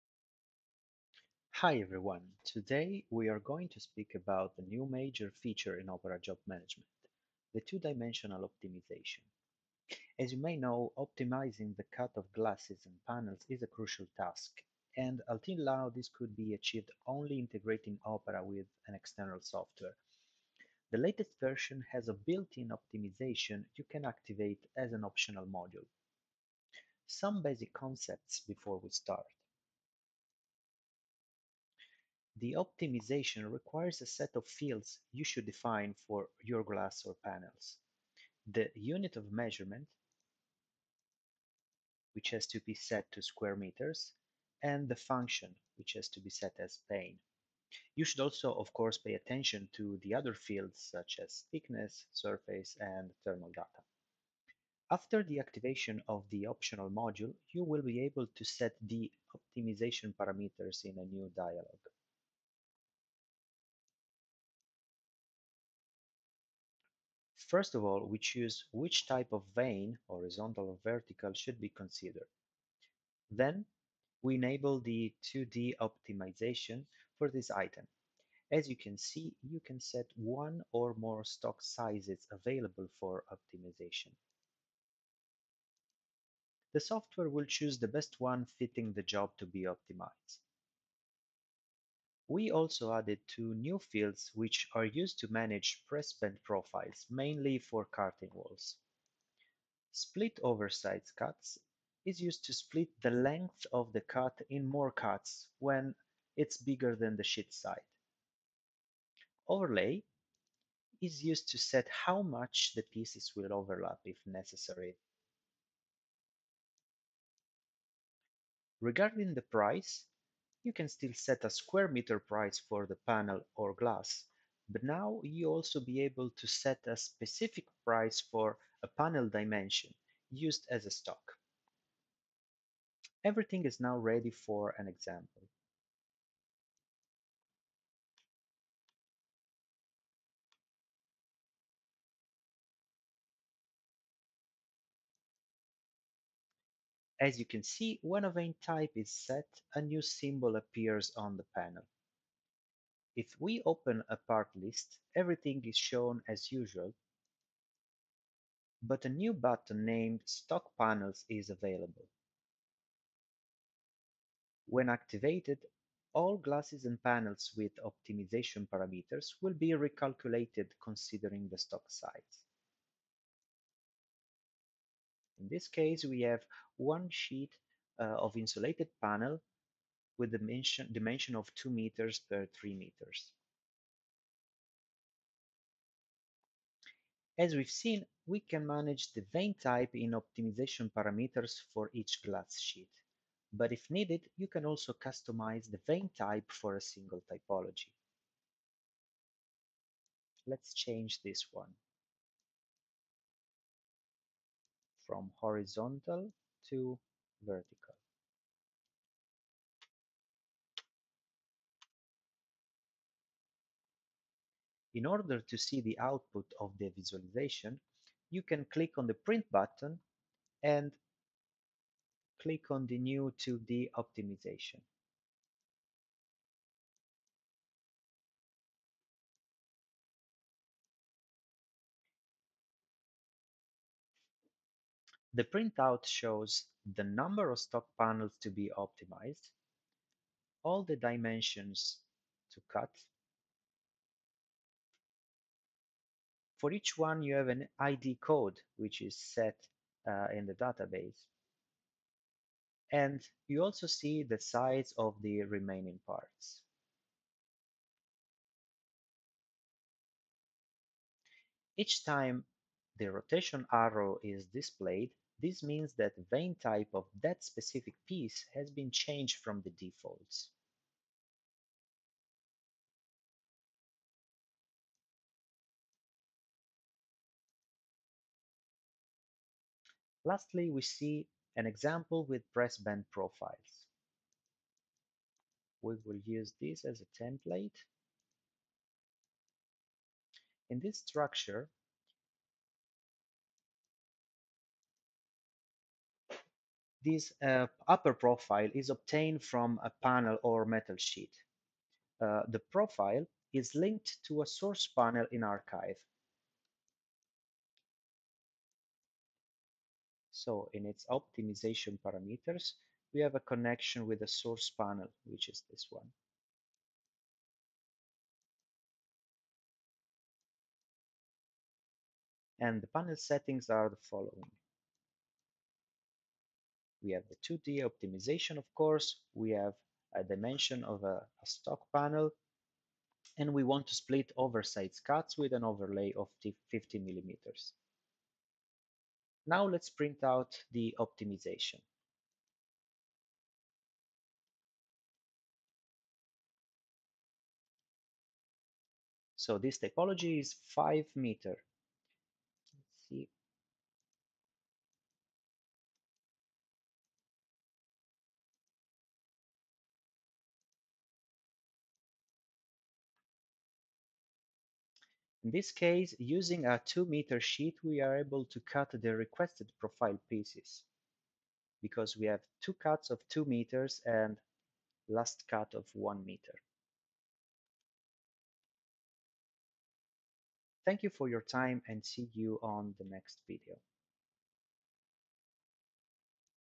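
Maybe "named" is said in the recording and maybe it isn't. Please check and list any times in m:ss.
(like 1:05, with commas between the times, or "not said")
2:39.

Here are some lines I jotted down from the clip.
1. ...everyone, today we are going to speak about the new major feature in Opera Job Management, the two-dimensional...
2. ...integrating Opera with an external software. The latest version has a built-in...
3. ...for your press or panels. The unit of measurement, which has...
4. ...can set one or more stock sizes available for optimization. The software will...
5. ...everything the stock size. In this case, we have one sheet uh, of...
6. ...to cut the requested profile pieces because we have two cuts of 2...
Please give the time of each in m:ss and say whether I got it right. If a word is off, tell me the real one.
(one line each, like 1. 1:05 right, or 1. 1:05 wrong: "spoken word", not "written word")
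1. 0:01 right
2. 0:17 right
3. 0:36 wrong: "glass", not "press"
4. 1:19 right
5. 2:50 wrong: "considering", not "everything"
6. 6:08 right.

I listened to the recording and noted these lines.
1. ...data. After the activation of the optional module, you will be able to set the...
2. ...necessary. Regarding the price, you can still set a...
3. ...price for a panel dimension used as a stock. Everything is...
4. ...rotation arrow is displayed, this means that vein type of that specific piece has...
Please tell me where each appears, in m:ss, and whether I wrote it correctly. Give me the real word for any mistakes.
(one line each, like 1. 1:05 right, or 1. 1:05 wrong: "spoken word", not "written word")
1. 0:53 right
2. 1:54 right
3. 2:07 right
4. 4:23 right.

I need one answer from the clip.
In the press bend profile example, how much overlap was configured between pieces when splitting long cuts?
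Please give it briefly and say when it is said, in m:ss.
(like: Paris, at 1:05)
50 millimeters, at 5:36.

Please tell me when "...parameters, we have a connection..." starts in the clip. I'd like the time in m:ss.
5:12.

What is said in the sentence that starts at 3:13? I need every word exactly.
But if needed, you can also customize the vein type for a single typology.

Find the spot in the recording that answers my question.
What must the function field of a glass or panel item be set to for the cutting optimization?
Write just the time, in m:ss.
0:46.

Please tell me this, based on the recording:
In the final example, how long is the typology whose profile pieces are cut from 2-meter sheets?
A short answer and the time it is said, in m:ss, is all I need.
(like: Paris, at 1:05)
5 meters, at 5:50.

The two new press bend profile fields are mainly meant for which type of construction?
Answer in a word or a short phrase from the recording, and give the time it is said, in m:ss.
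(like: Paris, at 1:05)
curtain walls, at 1:37.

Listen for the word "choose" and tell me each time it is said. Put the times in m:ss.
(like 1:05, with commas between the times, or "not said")
1:08, 1:27.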